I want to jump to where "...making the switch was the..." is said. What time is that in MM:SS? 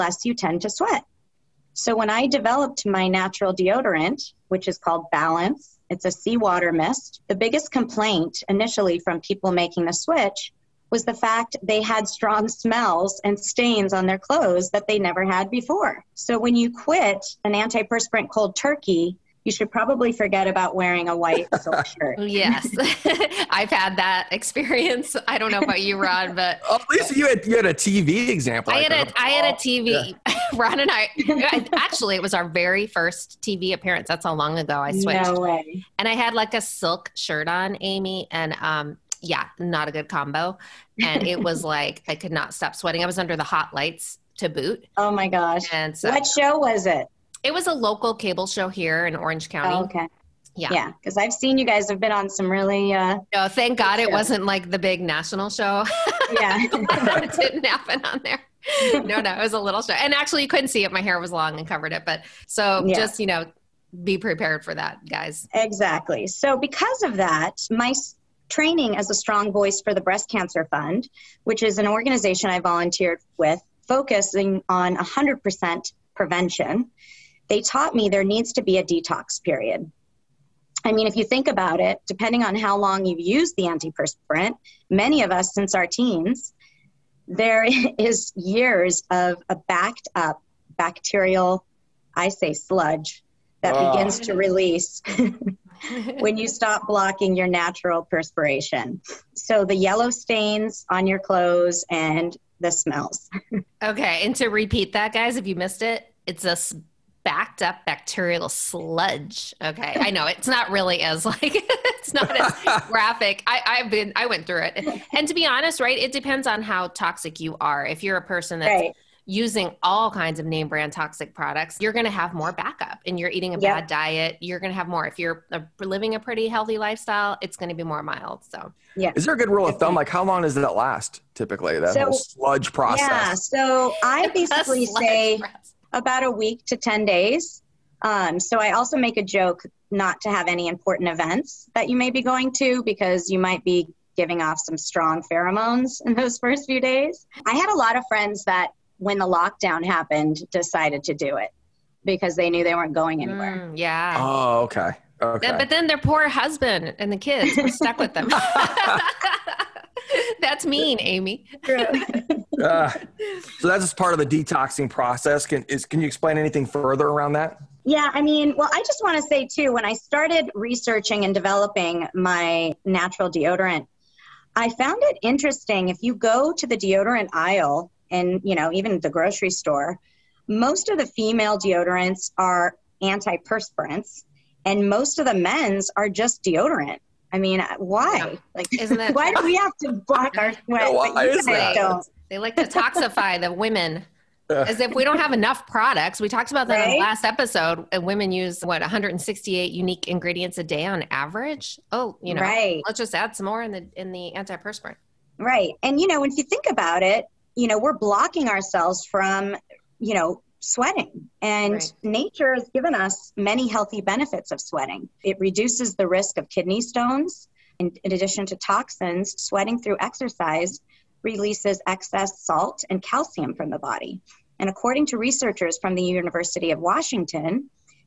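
00:09.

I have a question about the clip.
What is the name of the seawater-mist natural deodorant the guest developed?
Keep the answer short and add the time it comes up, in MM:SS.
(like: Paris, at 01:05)
Balance, at 00:05.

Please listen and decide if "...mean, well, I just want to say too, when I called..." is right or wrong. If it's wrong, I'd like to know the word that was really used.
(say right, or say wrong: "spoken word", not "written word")
wrong: "started", not "called".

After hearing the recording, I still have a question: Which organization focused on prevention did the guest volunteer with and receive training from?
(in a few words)
Breast Cancer Fund.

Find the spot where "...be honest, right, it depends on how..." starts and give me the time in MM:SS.
01:55.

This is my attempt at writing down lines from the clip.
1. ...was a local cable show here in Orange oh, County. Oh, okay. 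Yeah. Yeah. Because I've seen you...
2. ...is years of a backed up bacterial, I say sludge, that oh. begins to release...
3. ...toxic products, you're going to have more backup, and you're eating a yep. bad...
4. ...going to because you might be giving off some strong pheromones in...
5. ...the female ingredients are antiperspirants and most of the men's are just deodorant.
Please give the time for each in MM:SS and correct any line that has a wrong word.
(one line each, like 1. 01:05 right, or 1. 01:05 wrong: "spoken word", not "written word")
1. 00:47 right
2. 01:27 right
3. 02:00 right
4. 02:22 right
5. 03:00 wrong: "deodorants", not "ingredients".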